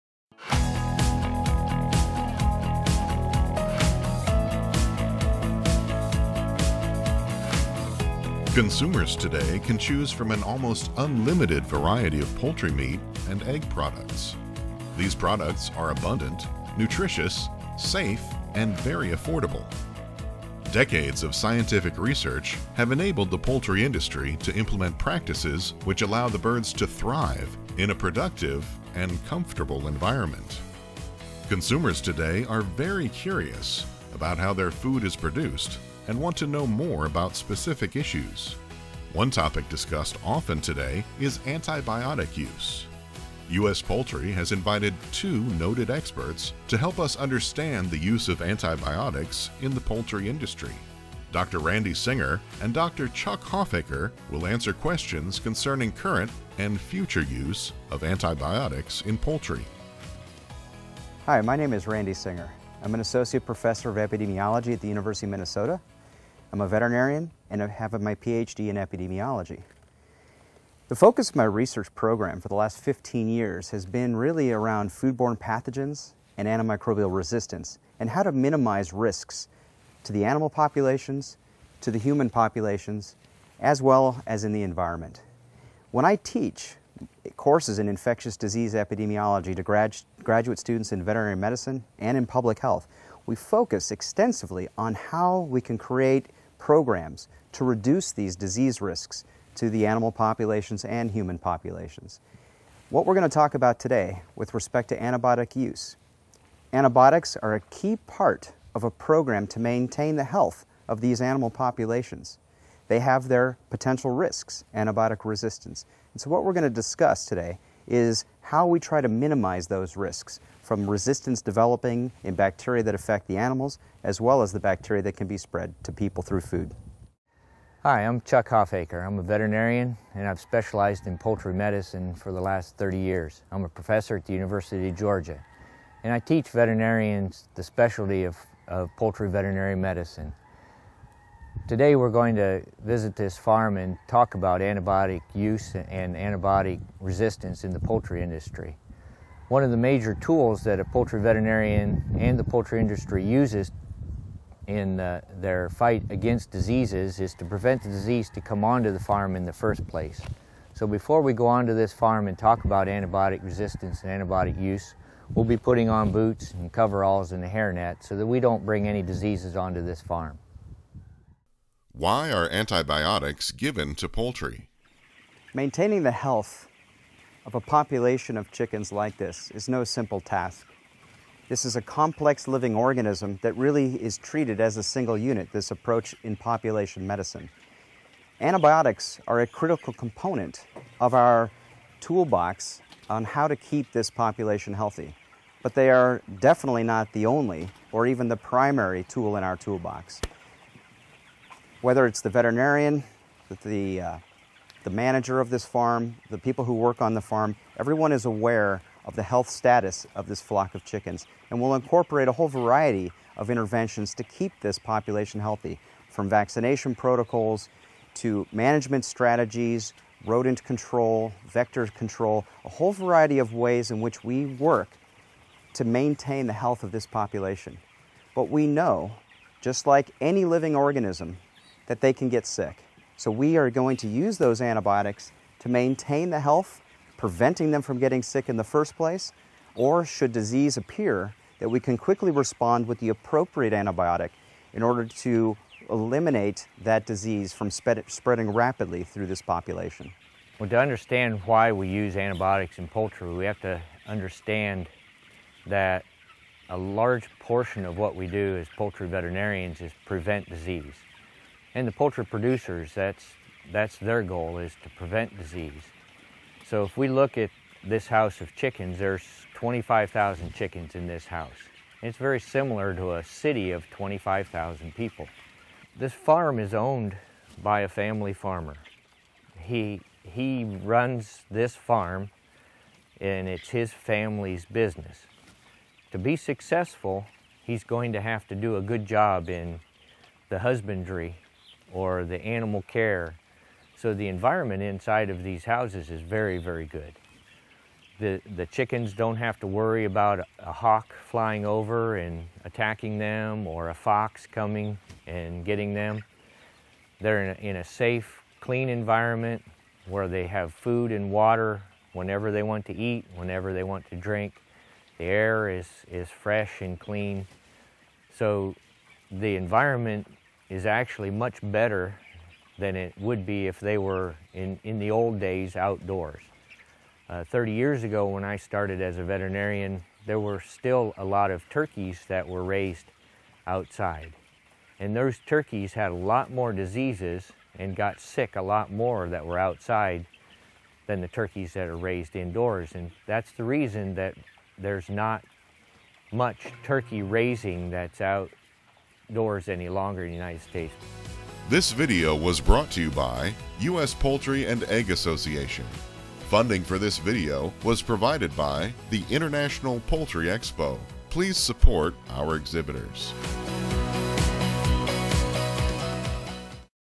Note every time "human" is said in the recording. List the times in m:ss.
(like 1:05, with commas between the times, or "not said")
1:21, 1:41.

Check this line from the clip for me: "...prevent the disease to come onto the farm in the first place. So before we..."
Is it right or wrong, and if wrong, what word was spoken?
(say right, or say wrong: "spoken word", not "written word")
right.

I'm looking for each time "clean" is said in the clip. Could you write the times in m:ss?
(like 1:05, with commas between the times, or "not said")
5:08, 5:16.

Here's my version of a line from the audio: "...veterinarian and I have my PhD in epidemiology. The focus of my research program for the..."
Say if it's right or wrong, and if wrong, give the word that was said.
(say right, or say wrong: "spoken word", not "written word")
right.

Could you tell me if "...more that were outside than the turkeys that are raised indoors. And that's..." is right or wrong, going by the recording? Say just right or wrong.
right.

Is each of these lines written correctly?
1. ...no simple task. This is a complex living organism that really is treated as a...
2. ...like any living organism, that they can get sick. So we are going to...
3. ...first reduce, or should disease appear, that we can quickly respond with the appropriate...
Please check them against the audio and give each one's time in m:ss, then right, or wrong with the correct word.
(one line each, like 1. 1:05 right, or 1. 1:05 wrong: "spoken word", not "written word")
1. 2:59 right
2. 3:49 right
3. 3:58 wrong: "place", not "reduce".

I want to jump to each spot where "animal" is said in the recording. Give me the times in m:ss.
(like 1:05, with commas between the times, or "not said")
1:20, 1:39, 1:51, 2:03, 4:52.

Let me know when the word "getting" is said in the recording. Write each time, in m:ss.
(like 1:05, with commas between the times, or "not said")
3:57, 5:05.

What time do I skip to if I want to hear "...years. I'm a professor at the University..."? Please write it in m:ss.
2:12.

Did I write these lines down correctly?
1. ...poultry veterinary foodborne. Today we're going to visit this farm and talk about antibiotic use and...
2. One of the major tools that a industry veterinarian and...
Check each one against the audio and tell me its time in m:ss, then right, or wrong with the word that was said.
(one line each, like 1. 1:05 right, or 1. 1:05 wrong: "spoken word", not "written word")
1. 2:18 wrong: "medicine", not "foodborne"
2. 2:29 wrong: "poultry", not "industry".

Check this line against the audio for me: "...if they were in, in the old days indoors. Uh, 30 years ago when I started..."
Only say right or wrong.
wrong.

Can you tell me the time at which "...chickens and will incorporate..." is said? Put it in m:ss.
3:30.